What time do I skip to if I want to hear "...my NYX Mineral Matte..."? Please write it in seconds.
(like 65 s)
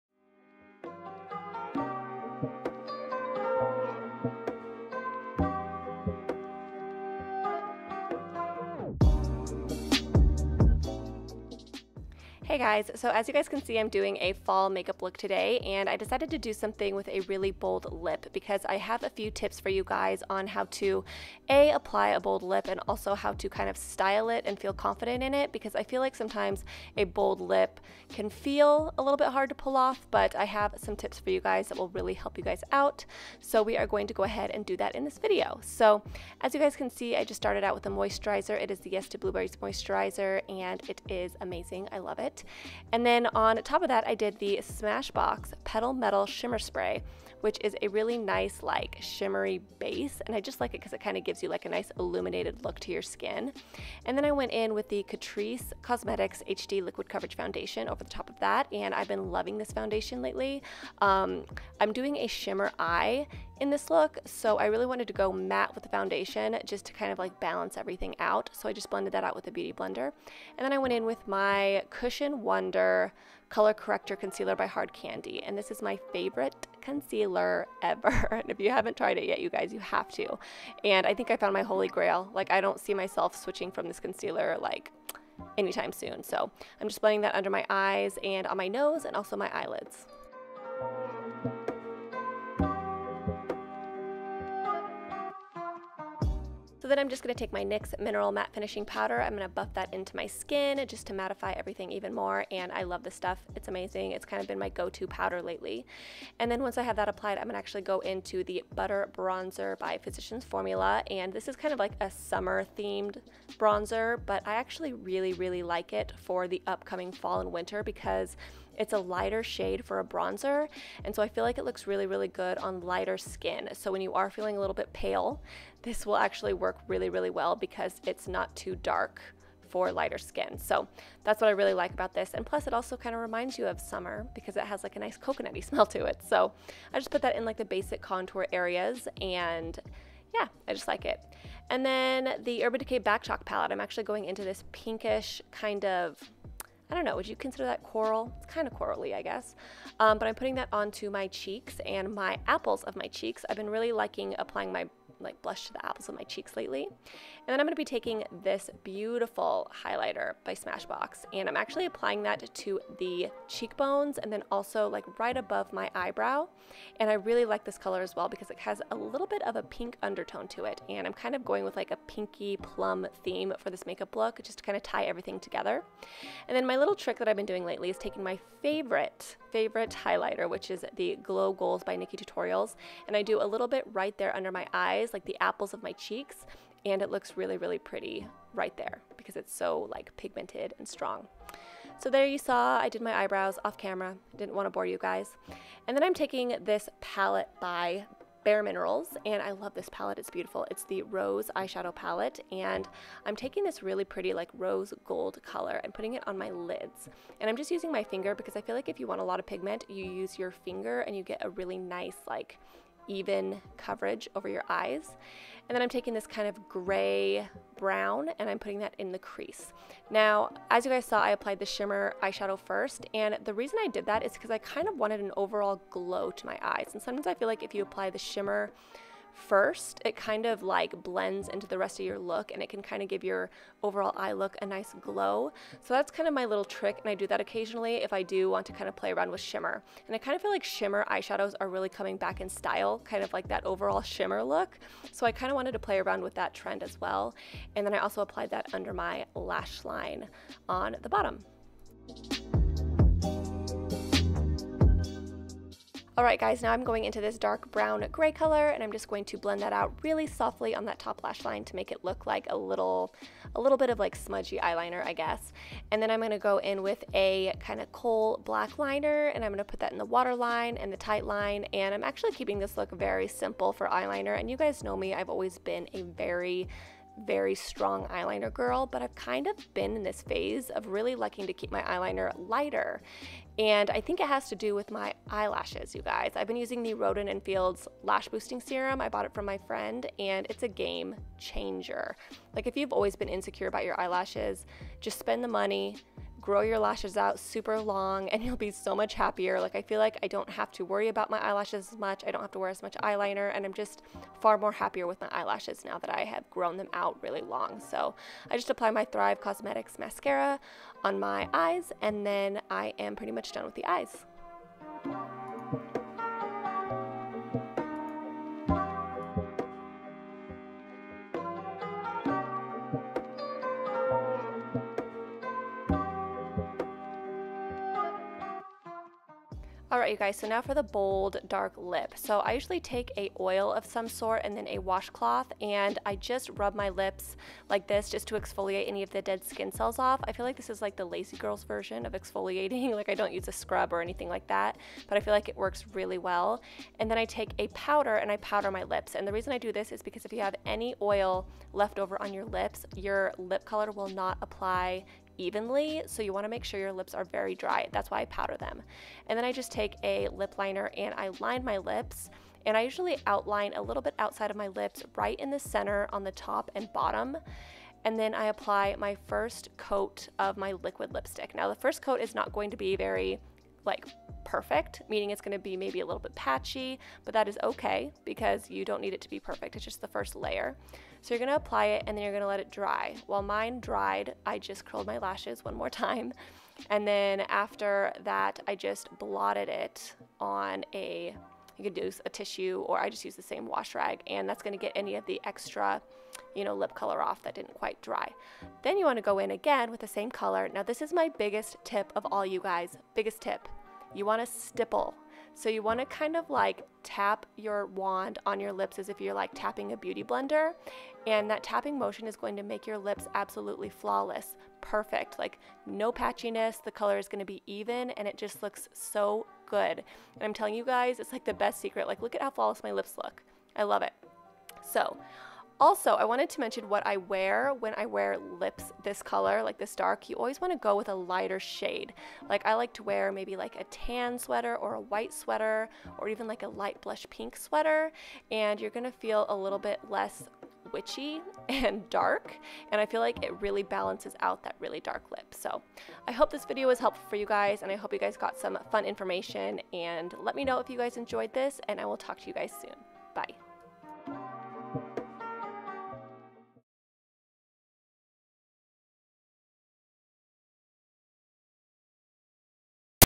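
97 s.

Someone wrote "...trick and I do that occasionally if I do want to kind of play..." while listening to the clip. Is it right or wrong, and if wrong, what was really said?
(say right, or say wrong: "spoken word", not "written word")
right.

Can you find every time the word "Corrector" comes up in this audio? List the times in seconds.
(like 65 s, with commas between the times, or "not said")
73 s.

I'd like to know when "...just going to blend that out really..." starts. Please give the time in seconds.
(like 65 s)
258 s.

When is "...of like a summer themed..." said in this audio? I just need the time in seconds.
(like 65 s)
111 s.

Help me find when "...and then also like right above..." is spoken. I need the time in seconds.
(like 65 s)
164 s.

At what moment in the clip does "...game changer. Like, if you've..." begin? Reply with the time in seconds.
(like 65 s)
290 s.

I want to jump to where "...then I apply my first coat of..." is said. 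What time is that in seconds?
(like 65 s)
368 s.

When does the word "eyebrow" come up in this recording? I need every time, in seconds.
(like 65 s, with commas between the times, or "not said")
165 s, 193 s.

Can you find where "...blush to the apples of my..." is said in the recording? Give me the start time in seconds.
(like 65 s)
155 s.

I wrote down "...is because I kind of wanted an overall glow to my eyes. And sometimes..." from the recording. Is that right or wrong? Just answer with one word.
right.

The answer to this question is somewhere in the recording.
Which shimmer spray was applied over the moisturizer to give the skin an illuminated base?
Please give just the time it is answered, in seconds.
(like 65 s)
44 s.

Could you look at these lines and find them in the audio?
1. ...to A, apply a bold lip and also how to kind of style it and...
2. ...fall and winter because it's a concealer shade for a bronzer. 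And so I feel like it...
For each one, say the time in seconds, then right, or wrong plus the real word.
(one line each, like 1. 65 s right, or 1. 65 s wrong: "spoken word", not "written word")
1. 20 s right
2. 117 s wrong: "lighter", not "concealer".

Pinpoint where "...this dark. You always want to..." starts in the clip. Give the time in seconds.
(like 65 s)
429 s.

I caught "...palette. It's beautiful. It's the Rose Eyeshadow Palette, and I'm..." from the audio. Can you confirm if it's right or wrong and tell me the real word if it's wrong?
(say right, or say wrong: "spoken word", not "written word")
right.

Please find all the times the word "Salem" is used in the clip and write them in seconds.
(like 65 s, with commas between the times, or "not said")
not said.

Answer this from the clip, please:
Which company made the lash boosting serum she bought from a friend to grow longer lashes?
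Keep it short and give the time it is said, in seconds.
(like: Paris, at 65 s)
Rodan and Fields, at 286 s.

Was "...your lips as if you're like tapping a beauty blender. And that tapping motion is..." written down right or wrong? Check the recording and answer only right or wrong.
right.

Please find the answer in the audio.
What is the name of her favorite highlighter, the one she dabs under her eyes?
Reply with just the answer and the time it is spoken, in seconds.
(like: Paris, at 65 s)
Glow Goals, at 181 s.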